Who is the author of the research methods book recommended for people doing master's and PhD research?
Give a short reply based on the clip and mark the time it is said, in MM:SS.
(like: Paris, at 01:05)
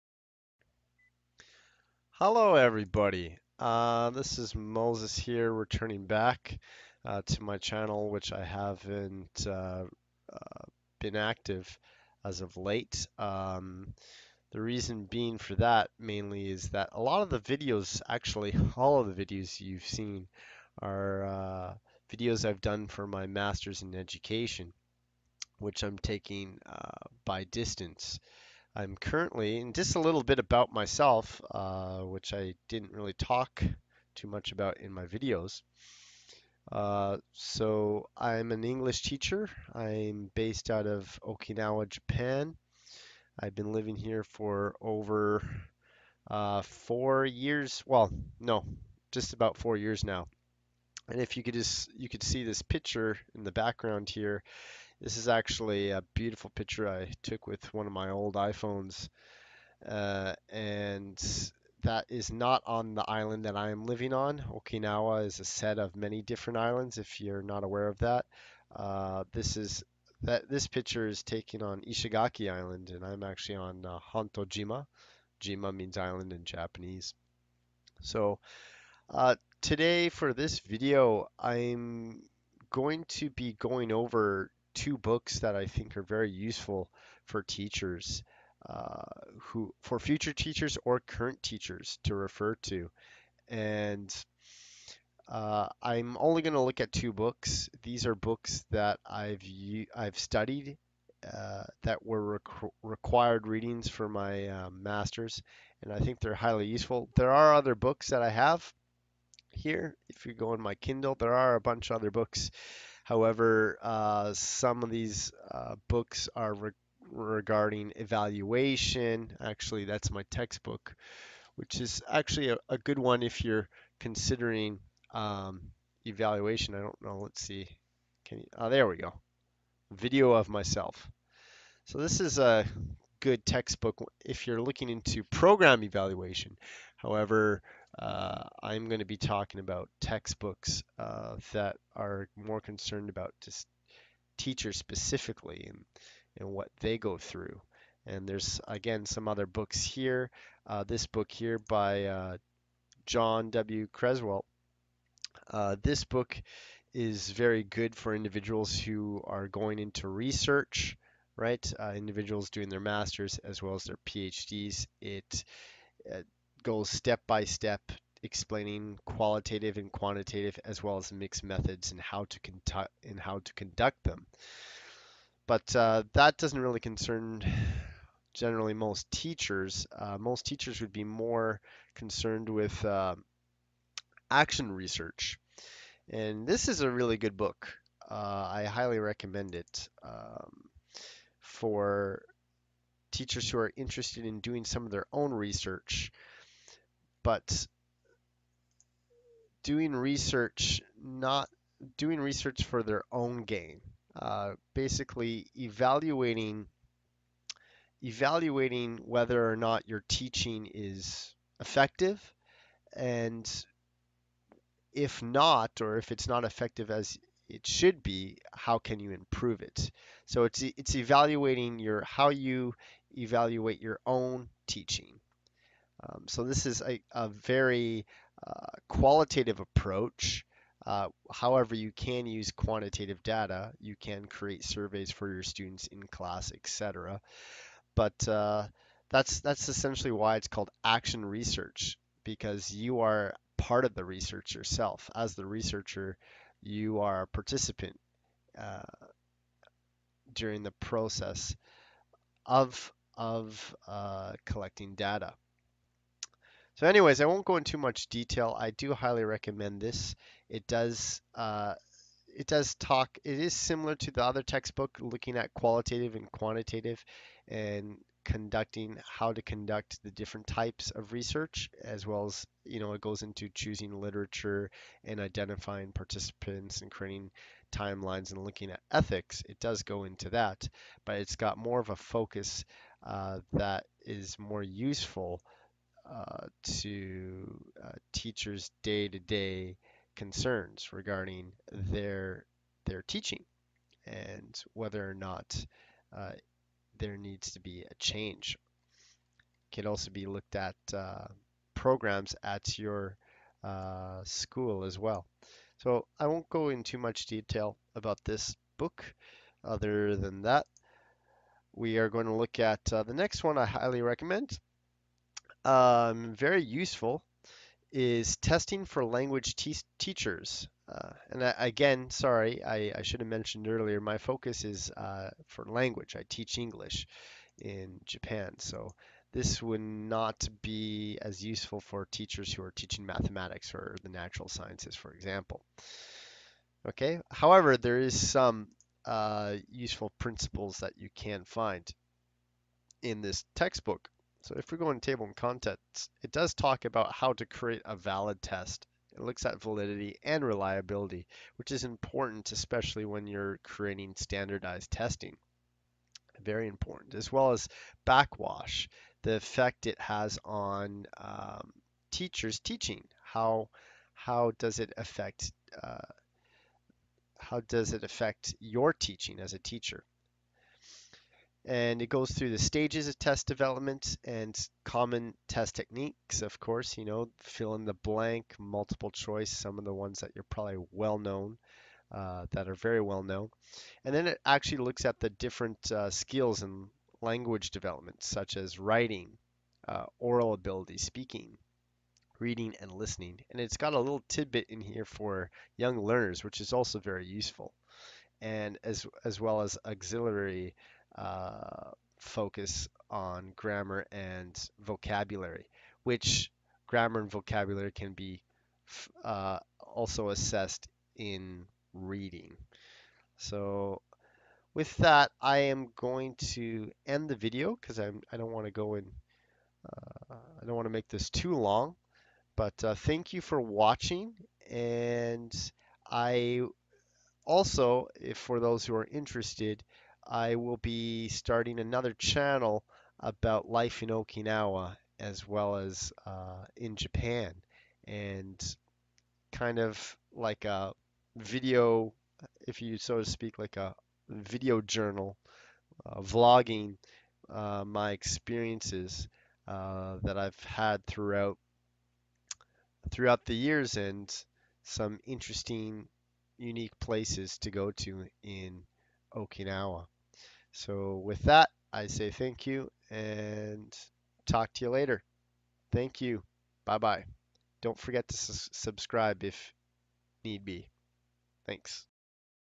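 John W. Creswell, at 02:33.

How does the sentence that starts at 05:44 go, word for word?
So if we go in table and contents, it does talk about how to create a valid test.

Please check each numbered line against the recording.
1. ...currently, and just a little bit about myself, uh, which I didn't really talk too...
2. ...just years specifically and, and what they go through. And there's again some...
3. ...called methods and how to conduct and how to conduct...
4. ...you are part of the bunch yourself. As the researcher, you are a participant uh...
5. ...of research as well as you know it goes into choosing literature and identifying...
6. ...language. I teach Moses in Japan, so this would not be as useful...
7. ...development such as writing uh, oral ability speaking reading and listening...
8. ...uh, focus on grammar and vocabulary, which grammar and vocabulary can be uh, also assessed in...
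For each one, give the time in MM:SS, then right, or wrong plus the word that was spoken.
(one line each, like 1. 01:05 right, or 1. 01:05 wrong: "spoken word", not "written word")
1. 00:28 right
2. 02:23 wrong: "teachers", not "years"
3. 02:51 wrong: "mixed", not "called"
4. 04:02 wrong: "research", not "bunch"
5. 04:30 right
6. 05:25 wrong: "English", not "Moses"
7. 06:27 right
8. 06:41 right.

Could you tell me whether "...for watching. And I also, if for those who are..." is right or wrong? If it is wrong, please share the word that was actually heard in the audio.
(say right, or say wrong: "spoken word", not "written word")
right.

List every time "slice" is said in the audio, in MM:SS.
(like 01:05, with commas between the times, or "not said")
not said.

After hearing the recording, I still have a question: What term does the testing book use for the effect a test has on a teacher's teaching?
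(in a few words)
backwash.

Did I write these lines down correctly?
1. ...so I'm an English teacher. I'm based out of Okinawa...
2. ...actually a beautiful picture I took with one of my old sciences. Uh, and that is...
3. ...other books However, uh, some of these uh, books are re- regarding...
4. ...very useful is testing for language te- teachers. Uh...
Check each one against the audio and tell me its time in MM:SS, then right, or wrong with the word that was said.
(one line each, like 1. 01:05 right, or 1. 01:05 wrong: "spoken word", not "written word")
1. 00:37 right
2. 00:55 wrong: "iPhones", not "sciences"
3. 01:51 right
4. 05:16 right.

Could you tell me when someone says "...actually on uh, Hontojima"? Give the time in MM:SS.
01:13.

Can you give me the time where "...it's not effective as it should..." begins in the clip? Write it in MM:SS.
03:36.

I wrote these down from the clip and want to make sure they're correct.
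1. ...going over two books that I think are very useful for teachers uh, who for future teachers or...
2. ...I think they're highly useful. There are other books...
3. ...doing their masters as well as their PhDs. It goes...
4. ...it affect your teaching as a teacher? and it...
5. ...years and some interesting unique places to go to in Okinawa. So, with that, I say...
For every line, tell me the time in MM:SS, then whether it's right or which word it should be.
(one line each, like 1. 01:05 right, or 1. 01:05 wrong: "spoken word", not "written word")
1. 01:23 right
2. 01:45 right
3. 02:42 right
4. 06:07 right
5. 07:33 right.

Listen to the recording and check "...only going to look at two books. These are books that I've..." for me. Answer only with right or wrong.
right.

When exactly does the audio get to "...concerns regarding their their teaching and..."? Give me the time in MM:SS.
04:50.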